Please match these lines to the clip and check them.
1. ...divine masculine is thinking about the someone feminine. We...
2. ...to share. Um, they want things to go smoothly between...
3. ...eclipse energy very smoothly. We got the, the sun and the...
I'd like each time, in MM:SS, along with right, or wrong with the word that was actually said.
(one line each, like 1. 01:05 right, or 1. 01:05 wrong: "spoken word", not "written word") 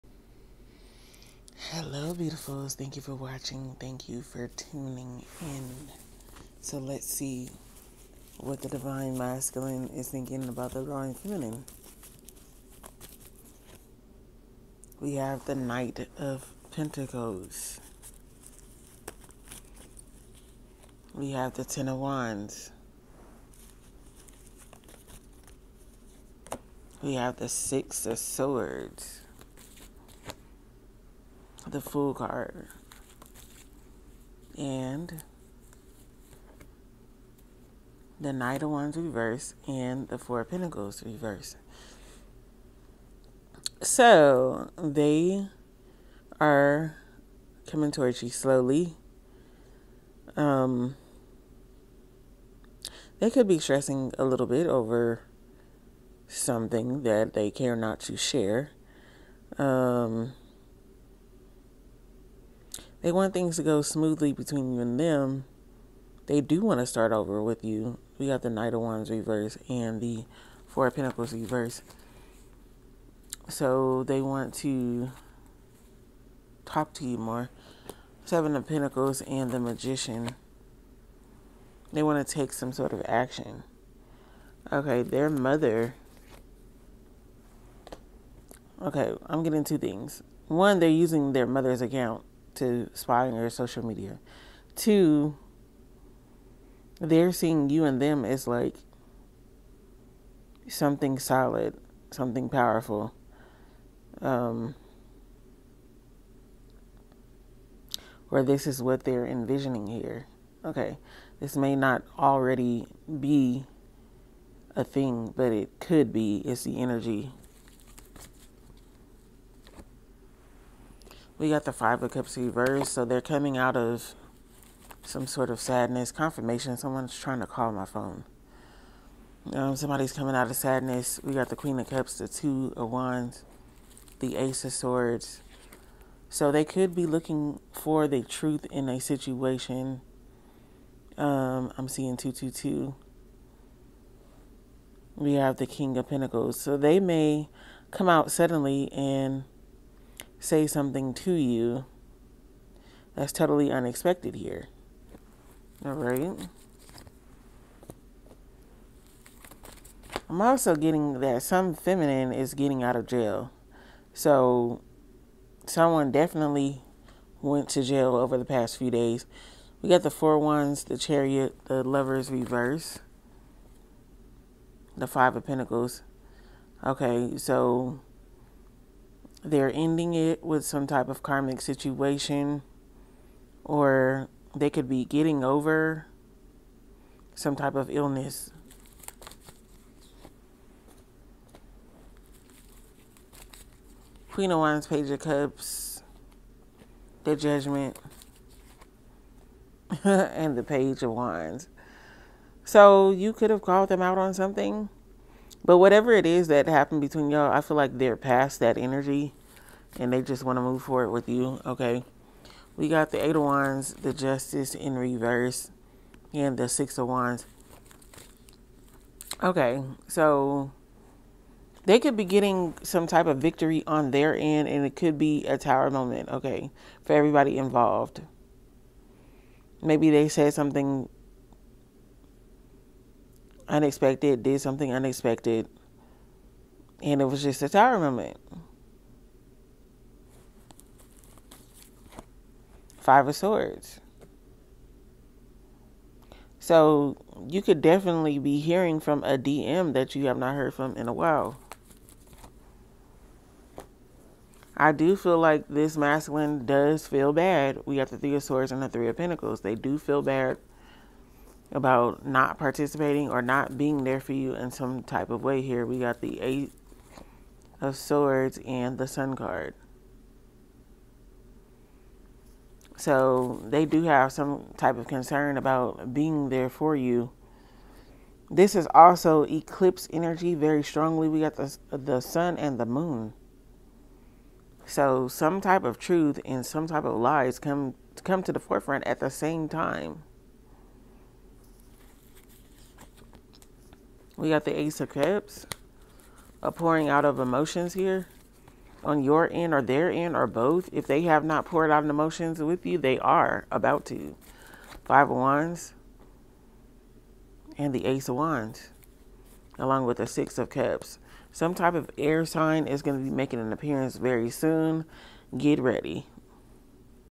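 1. 00:08 wrong: "divine", not "someone"
2. 00:58 right
3. 04:39 wrong: "strongly", not "smoothly".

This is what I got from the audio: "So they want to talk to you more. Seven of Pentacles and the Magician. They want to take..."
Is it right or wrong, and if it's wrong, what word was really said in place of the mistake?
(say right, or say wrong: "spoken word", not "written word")
right.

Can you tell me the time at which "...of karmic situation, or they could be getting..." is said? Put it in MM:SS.
03:01.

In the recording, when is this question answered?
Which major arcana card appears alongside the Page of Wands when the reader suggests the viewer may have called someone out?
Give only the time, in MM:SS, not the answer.
03:17.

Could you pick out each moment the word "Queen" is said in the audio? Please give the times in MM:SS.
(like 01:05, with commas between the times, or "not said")
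02:11, 03:14.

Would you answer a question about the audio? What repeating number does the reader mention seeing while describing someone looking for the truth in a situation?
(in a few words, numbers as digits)
222.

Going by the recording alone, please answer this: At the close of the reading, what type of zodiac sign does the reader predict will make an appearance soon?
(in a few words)
Air sign.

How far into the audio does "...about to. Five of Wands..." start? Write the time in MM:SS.
05:03.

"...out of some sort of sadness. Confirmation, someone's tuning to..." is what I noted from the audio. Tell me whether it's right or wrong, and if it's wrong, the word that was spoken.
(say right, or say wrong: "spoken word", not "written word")
wrong: "trying", not "tuning".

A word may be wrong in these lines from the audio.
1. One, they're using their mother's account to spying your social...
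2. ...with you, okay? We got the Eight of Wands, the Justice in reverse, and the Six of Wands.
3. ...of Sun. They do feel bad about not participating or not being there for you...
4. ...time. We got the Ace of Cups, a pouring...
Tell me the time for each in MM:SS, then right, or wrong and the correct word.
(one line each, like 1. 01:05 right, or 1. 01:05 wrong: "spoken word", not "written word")
1. 01:30 right
2. 03:31 right
3. 04:19 wrong: "Pentacles", not "Sun"
4. 04:49 right.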